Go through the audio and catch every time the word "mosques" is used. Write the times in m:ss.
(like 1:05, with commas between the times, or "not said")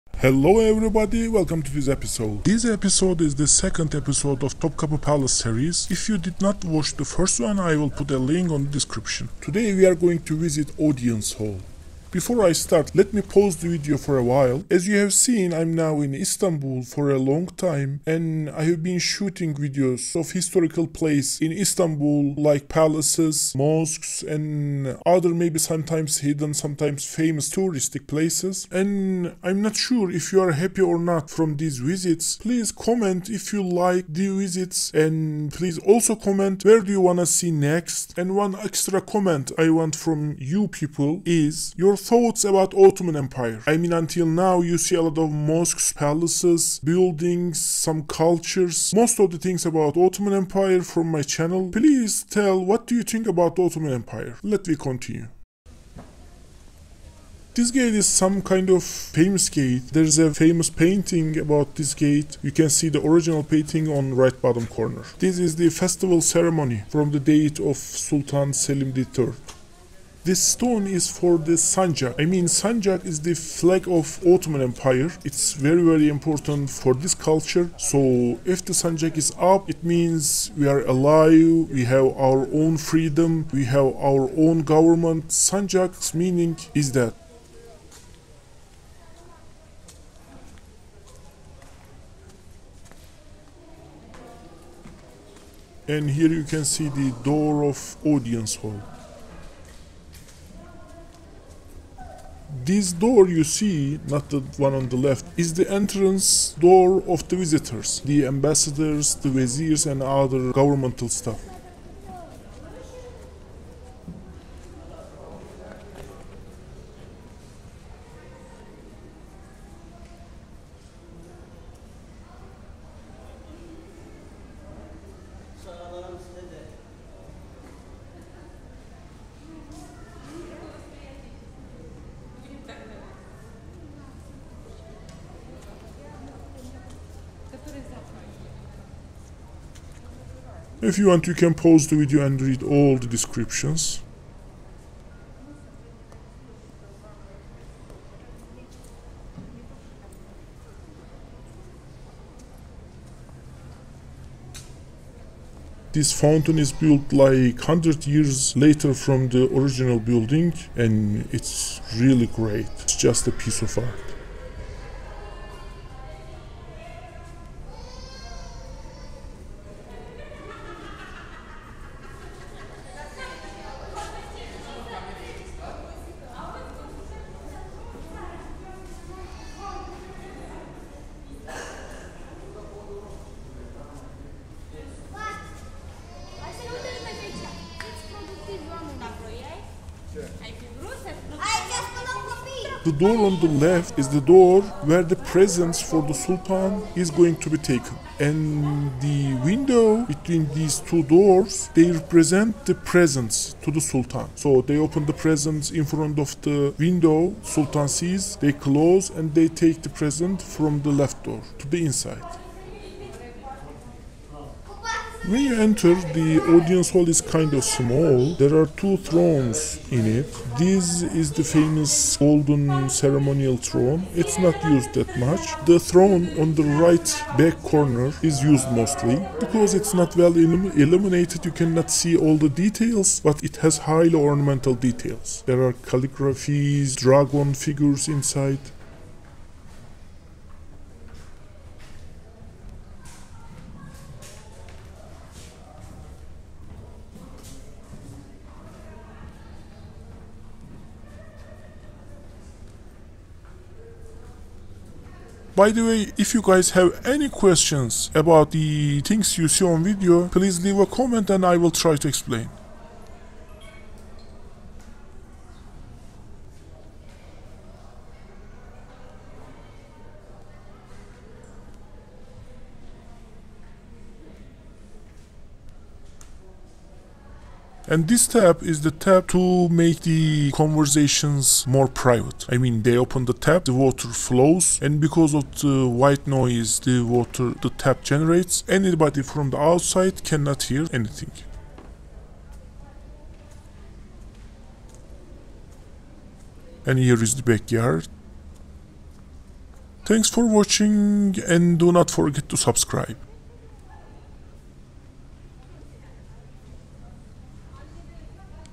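0:23, 0:45.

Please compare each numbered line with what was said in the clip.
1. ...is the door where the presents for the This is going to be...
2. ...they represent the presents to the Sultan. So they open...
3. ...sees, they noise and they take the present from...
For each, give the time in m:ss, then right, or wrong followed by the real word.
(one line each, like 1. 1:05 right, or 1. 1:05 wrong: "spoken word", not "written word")
1. 3:13 wrong: "Sultan", not "This"
2. 3:21 right
3. 3:27 wrong: "close", not "noise".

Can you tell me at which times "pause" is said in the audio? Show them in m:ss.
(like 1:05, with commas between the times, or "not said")
0:13, 2:21.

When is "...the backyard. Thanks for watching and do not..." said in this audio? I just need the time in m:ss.
4:57.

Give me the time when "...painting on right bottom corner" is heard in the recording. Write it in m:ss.
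1:03.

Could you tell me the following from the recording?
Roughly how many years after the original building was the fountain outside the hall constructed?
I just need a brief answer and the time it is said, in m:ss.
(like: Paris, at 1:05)
100 years, at 2:37.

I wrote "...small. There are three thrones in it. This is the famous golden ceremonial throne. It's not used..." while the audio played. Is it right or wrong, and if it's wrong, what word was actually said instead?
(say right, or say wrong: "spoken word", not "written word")
wrong: "two", not "three".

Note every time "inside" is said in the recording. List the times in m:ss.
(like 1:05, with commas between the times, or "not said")
3:31, 3:58.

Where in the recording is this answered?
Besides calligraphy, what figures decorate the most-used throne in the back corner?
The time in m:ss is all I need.
3:56.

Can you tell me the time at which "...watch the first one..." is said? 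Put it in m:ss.
0:06.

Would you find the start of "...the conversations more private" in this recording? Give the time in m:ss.
4:40.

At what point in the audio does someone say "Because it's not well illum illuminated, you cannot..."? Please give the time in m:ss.
3:49.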